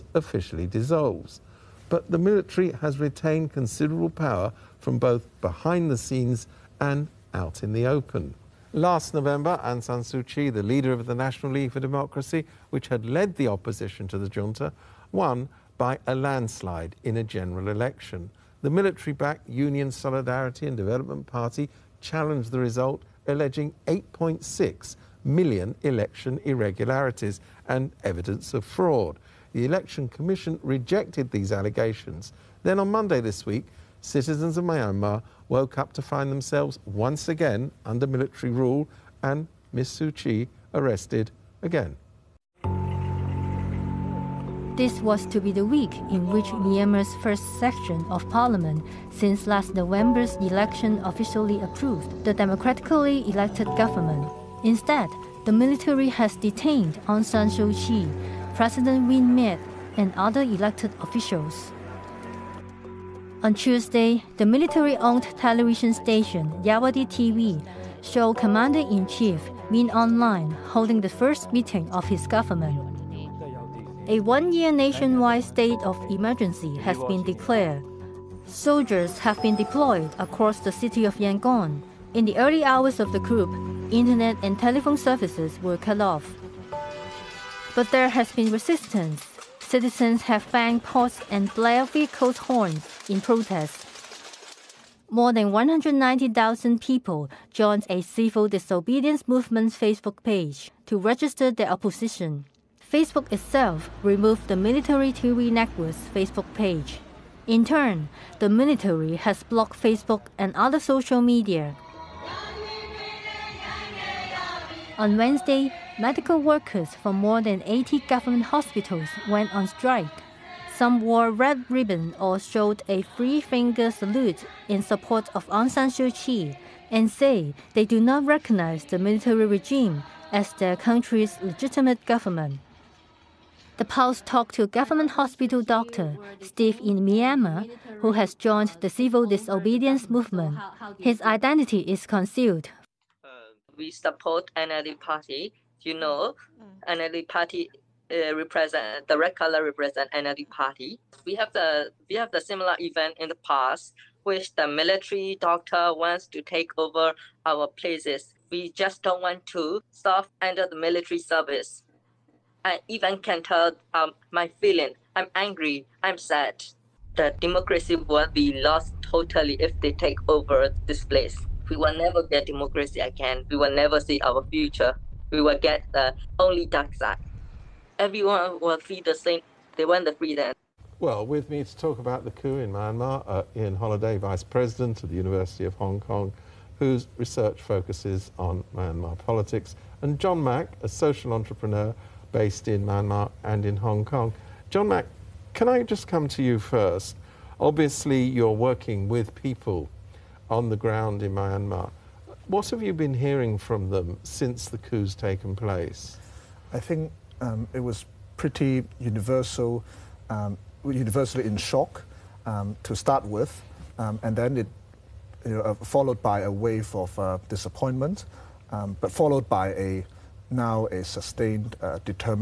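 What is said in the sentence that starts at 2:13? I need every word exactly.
The Pulse talked to government hospital doctor Steve in Myanmar, who has joined the civil disobedience movement.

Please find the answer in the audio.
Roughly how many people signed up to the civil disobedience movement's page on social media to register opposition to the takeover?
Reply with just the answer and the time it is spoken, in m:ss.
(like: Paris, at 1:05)
190,000, at 1:35.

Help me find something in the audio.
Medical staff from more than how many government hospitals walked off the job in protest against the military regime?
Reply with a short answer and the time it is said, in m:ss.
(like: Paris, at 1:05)
80, at 1:57.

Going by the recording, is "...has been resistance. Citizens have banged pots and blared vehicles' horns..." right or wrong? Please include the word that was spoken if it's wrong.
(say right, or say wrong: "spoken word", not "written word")
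right.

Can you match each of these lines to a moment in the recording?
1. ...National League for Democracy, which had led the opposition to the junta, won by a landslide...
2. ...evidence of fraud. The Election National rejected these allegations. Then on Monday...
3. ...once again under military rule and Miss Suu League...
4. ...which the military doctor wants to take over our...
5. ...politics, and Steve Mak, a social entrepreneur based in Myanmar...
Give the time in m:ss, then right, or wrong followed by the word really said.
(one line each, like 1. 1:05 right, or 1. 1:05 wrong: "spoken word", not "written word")
1. 0:11 right
2. 0:28 wrong: "Commission", not "National"
3. 0:36 wrong: "Kyi", not "League"
4. 2:34 right
5. 3:09 wrong: "John", not "Steve".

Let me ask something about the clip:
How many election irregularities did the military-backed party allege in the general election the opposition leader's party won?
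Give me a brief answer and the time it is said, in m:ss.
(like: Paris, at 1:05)
8.6 million, at 0:23.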